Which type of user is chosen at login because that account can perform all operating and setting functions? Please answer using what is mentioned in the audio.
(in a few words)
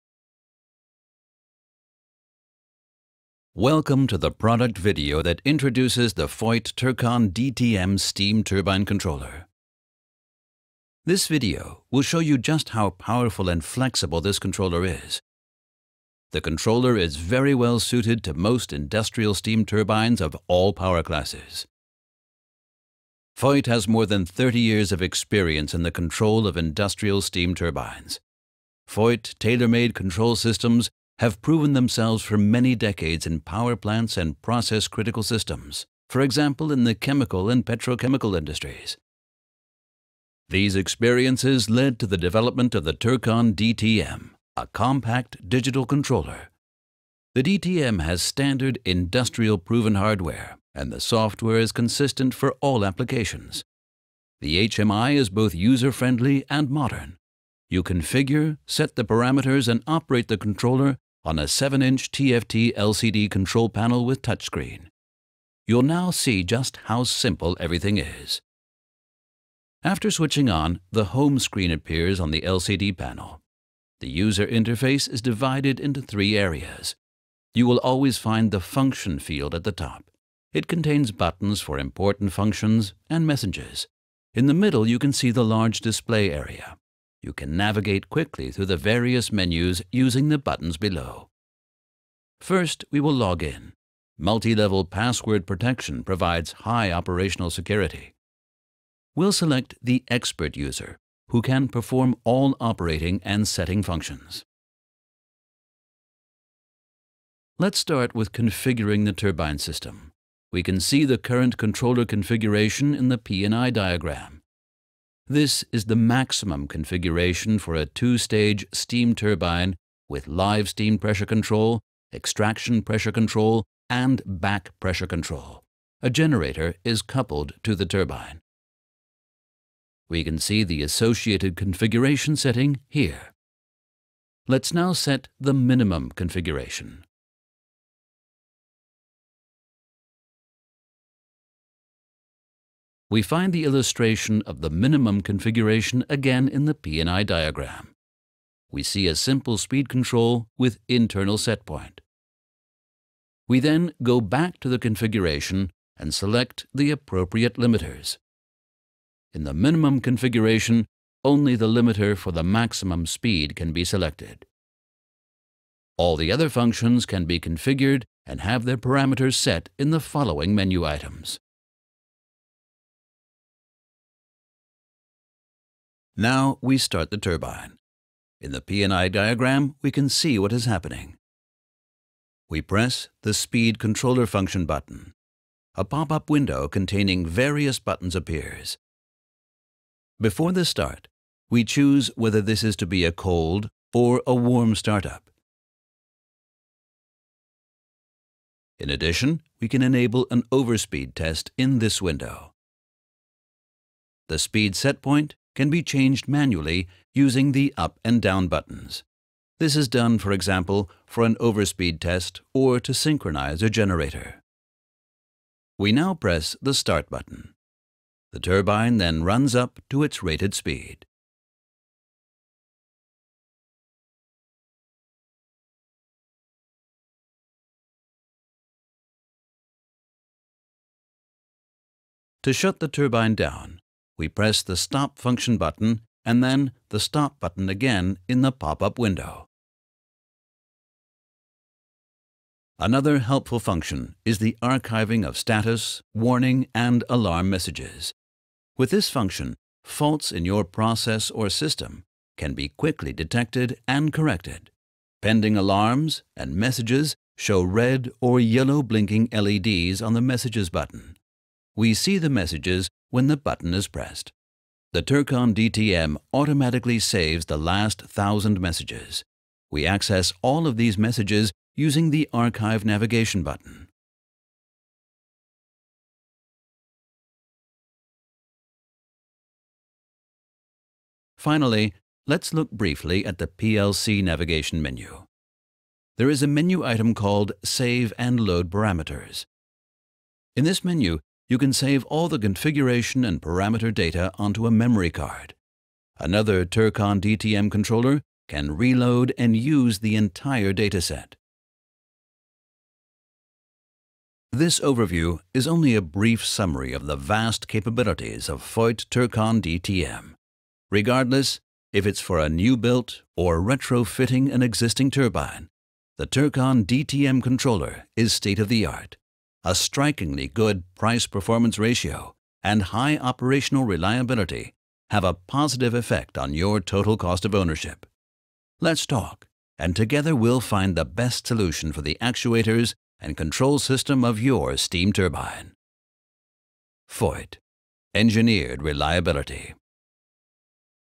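Expert user.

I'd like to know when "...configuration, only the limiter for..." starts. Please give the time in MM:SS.
02:39.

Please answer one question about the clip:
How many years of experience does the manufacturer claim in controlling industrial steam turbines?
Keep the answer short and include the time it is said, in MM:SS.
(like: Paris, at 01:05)
More than 30 years, at 00:23.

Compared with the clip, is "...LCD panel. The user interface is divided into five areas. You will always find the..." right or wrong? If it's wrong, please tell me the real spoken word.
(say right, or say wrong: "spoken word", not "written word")
wrong: "three", not "five".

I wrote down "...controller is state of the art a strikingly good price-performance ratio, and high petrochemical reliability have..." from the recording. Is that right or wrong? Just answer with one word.
wrong.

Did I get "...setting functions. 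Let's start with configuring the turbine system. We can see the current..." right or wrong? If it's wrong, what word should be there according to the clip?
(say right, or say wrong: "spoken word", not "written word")
right.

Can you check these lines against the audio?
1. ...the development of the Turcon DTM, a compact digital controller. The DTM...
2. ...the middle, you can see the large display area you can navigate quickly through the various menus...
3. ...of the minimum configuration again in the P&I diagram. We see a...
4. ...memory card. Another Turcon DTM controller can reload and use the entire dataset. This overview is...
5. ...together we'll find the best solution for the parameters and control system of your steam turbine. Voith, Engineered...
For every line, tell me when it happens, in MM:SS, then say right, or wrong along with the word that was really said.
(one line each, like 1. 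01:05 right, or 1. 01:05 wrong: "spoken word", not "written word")
1. 00:42 right
2. 01:24 right
3. 02:24 right
4. 04:54 right
5. 05:29 wrong: "actuators", not "parameters".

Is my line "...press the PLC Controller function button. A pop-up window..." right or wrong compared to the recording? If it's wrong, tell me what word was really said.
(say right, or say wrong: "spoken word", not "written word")
wrong: "Speed", not "PLC".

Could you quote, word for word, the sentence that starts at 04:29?
We access all of these messages using the Archive Navigation button.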